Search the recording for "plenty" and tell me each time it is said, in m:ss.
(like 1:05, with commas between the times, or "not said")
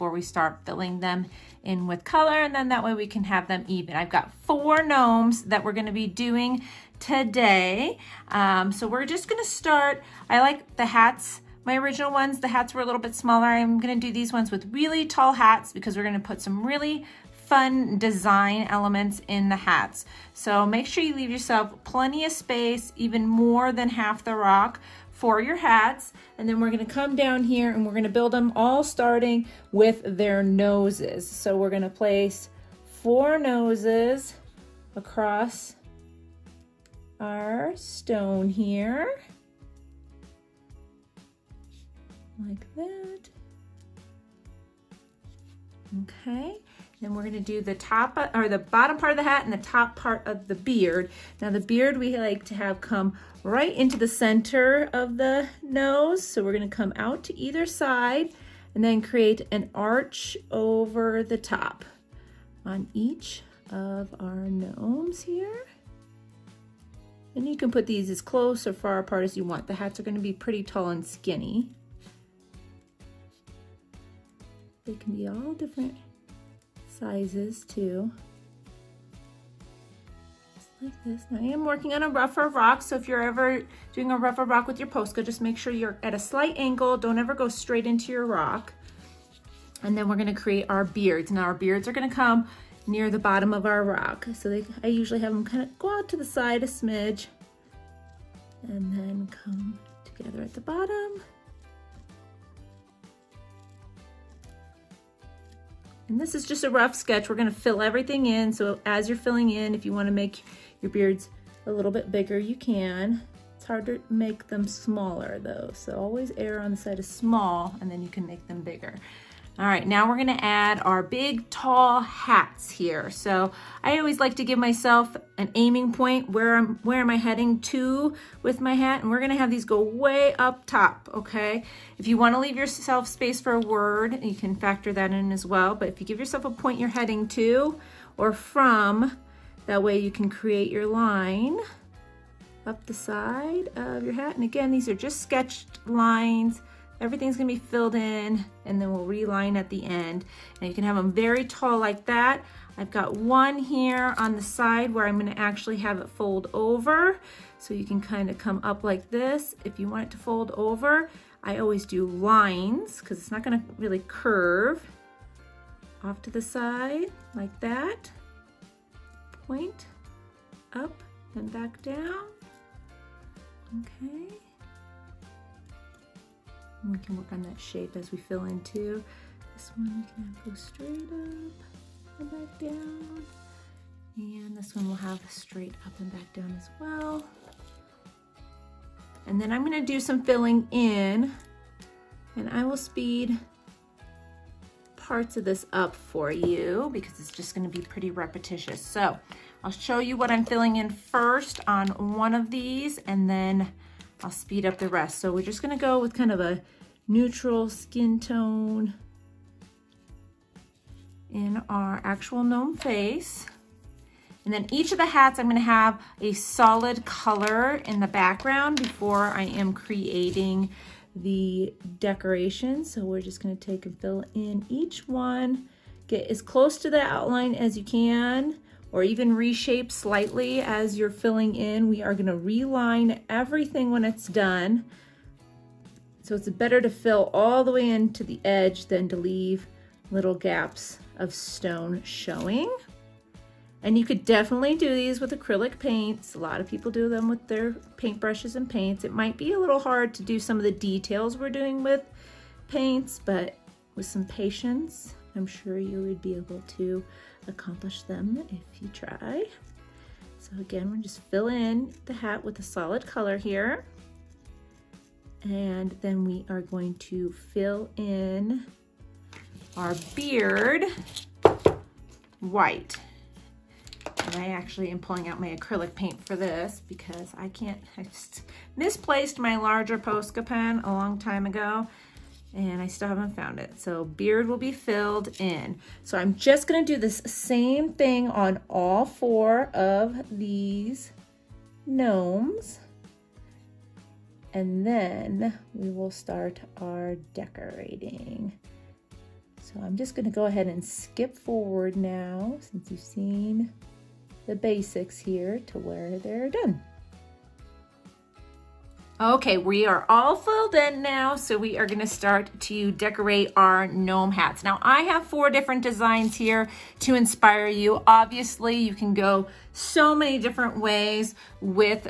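0:21.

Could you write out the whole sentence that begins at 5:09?
Okay, we are all filled in now, so we are gonna start to decorate our gnome hats.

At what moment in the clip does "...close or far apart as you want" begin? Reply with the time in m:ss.
1:08.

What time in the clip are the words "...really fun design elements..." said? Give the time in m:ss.
0:16.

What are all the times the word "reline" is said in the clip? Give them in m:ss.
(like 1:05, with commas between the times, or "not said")
2:29, 3:52.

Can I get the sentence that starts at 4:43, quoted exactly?
So beard will be filled in.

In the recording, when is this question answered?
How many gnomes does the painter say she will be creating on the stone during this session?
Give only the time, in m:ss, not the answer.
0:04.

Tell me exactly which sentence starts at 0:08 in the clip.
Um, so we're just gonna start, I like the hats, my original ones, the hats were a little bit smaller.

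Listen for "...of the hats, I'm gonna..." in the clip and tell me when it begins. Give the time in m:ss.
3:34.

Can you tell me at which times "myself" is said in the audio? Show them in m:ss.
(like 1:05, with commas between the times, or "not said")
2:04.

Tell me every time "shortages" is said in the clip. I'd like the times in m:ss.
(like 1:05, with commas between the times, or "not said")
not said.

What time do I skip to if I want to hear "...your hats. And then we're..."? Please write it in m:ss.
0:25.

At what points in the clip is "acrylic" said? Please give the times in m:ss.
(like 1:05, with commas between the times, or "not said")
4:05, 4:35.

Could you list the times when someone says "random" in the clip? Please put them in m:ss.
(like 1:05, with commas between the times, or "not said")
not said.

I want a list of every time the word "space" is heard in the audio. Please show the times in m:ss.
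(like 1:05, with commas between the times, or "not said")
0:22, 2:13.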